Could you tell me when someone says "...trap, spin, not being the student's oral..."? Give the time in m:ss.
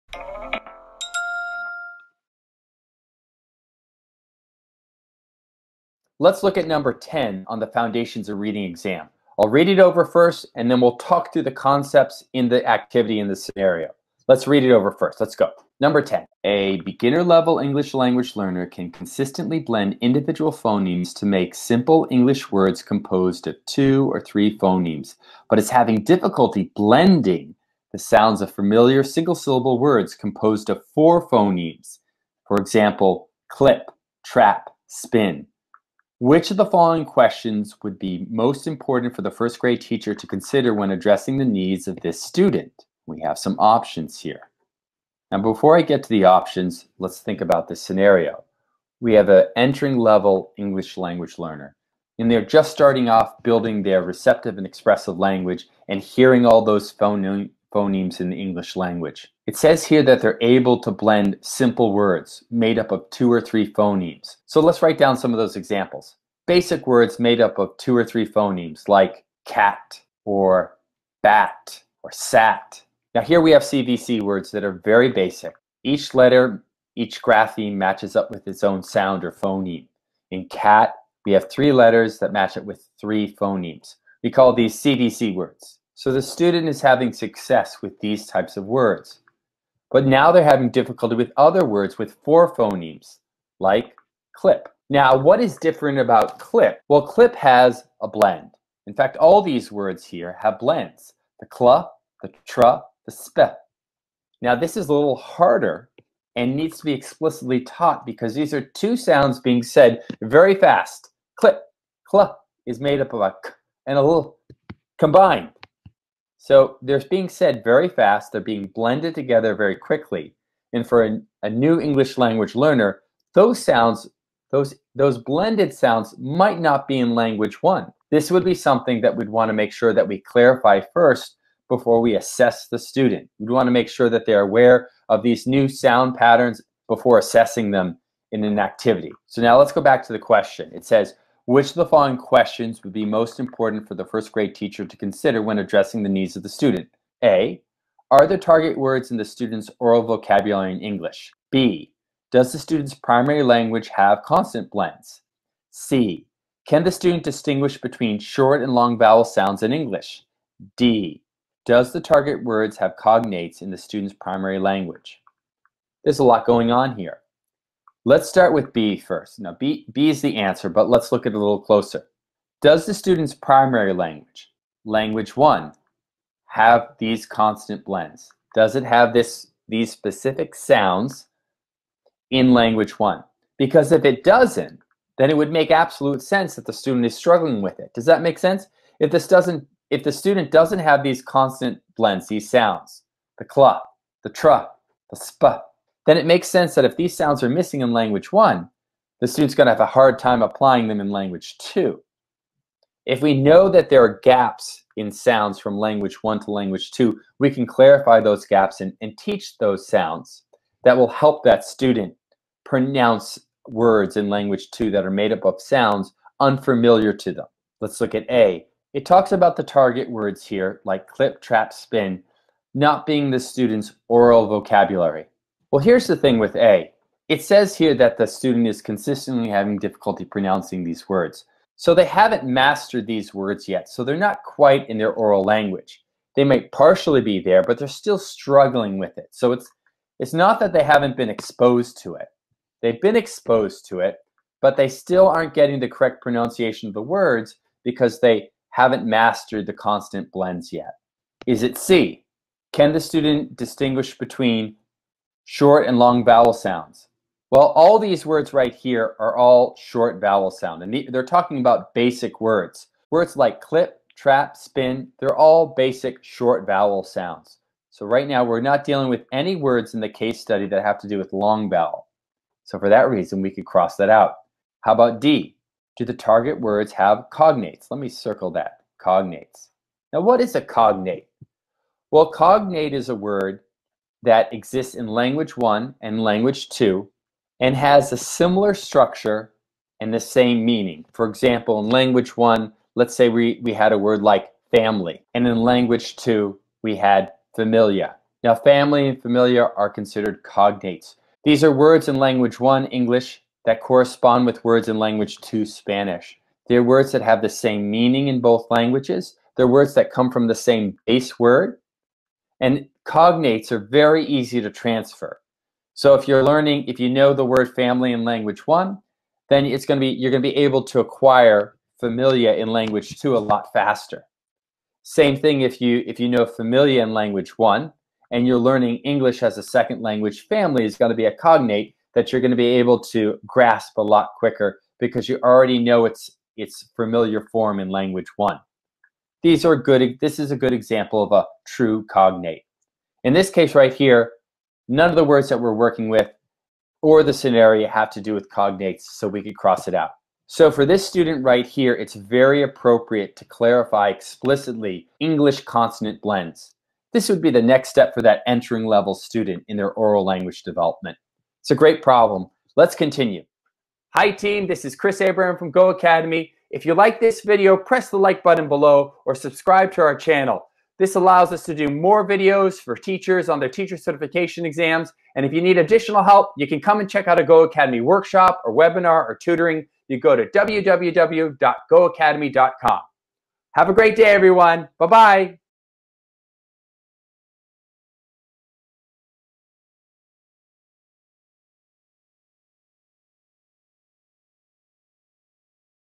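3:41.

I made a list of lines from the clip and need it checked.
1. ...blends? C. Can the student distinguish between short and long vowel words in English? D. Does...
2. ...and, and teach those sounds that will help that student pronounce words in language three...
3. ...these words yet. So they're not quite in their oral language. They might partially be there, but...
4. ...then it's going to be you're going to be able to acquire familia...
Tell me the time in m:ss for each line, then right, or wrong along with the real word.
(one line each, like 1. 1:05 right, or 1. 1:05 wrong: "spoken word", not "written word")
1. 2:34 wrong: "sounds", not "words"
2. 3:28 wrong: "two", not "three"
3. 3:53 right
4. 5:19 right.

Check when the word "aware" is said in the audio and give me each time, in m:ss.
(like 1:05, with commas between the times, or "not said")
2:14.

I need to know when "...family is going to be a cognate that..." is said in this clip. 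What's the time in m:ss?
5:30.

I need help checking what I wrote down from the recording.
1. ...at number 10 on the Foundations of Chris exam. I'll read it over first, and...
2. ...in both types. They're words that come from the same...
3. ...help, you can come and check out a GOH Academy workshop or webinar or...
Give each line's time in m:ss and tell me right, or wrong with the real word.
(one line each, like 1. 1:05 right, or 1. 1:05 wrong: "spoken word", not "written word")
1. 0:06 wrong: "Reading", not "Chris"
2. 5:08 wrong: "languages", not "types"
3. 6:16 right.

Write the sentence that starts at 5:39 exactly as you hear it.
These are good, this is a good example of a true cognate.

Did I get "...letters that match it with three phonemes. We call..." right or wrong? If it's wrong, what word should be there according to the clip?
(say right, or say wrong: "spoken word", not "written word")
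right.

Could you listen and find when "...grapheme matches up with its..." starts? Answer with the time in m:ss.
1:17.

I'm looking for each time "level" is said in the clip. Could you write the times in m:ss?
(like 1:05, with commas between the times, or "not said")
0:17, 0:49, 5:58.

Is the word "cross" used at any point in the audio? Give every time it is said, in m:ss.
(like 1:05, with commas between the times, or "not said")
4:33, 5:49.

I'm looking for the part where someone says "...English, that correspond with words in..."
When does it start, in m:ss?
5:02.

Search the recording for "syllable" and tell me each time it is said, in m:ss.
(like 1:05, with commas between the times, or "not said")
0:29.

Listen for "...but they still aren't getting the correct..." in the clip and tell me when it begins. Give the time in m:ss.
4:04.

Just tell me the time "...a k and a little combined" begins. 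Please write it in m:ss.
1:53.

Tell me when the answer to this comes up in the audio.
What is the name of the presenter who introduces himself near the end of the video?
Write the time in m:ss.
6:04.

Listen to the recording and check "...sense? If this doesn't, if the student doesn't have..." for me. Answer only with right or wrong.
right.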